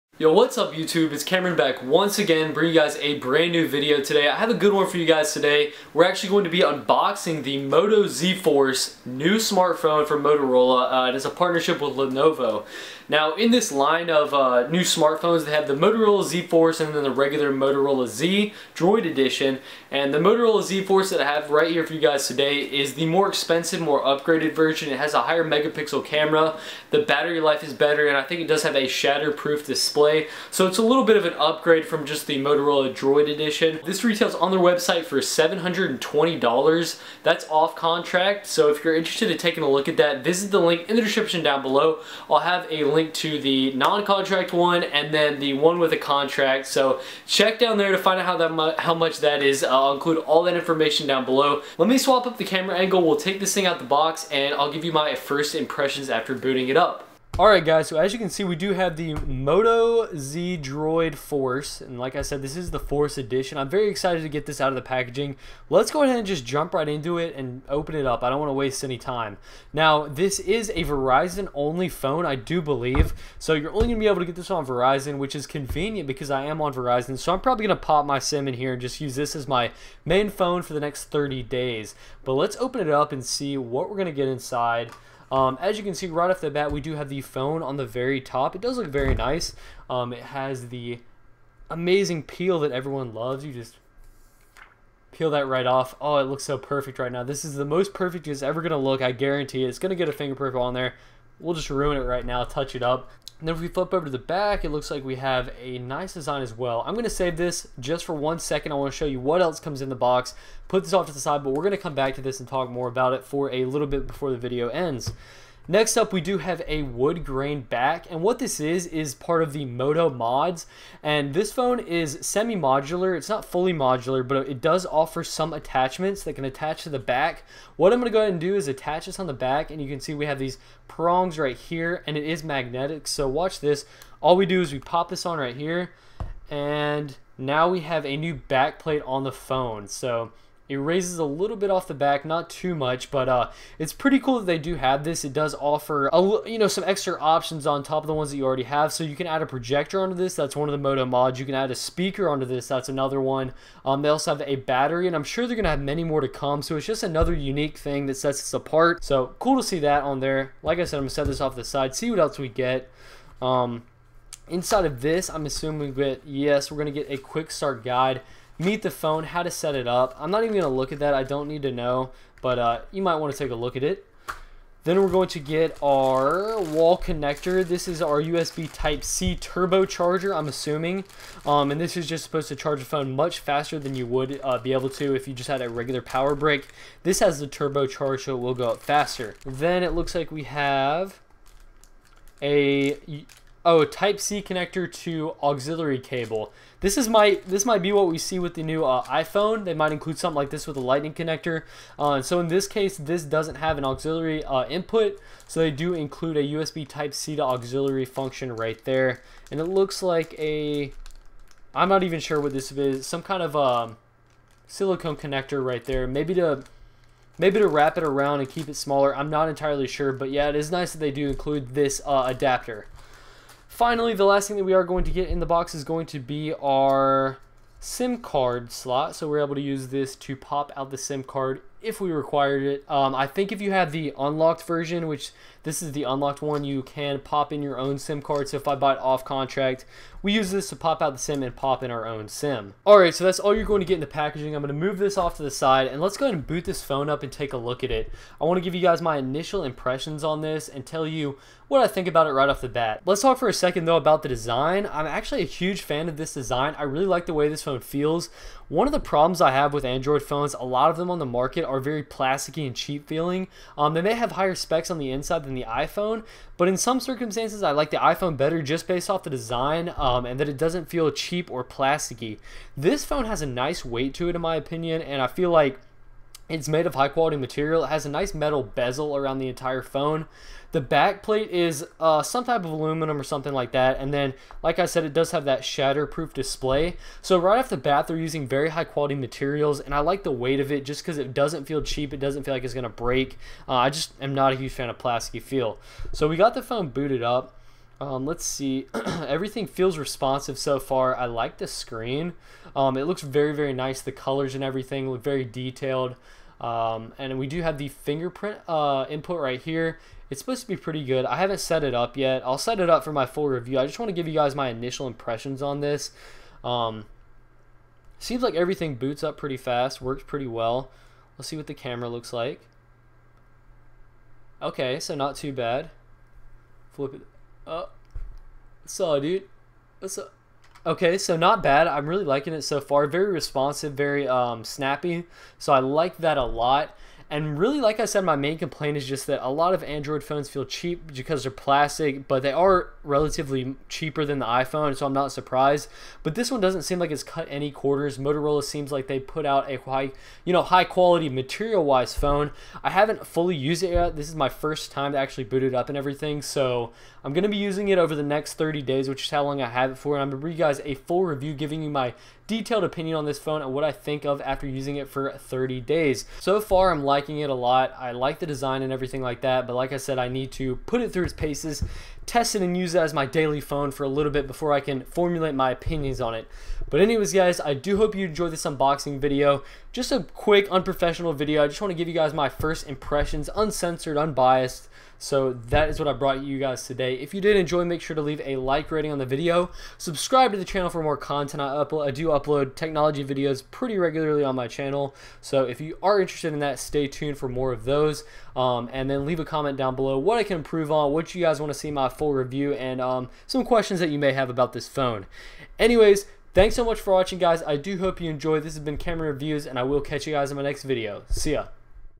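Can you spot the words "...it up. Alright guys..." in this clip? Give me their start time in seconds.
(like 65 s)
56 s.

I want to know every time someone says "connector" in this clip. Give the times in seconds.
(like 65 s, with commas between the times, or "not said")
176 s, 194 s, 201 s, 215 s.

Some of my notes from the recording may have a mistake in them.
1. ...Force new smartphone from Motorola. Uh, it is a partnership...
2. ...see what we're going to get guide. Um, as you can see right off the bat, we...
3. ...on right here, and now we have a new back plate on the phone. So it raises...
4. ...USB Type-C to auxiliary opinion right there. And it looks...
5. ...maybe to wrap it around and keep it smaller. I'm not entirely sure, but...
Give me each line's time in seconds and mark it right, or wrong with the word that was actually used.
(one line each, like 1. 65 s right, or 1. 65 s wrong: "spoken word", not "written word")
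1. 8 s right
2. 83 s wrong: "inside", not "guide"
3. 135 s right
4. 206 s wrong: "function", not "opinion"
5. 217 s right.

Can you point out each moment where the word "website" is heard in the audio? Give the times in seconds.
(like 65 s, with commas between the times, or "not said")
34 s.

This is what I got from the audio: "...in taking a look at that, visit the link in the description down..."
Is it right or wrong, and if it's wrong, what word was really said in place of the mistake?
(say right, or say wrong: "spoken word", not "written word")
right.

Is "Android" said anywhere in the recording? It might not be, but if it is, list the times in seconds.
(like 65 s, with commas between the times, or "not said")
259 s, 339 s.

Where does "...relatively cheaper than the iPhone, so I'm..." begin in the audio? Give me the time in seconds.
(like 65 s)
343 s.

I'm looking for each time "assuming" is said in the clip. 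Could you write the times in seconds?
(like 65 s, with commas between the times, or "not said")
165 s, 180 s.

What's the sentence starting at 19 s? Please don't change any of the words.
And the Motorola Z Force that I have right here for you guys today is the more expensive, more upgraded version.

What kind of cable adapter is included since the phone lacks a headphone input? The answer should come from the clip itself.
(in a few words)
Type-C to auxiliary.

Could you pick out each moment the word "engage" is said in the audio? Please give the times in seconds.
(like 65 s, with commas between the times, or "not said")
not said.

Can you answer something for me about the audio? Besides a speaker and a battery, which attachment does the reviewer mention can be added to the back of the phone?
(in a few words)
Projector.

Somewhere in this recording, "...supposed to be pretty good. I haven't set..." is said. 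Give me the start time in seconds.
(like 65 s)
310 s.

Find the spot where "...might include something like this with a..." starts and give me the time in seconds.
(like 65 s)
199 s.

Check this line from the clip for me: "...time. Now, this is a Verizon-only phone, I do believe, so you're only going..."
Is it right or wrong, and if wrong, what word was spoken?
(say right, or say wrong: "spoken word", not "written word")
right.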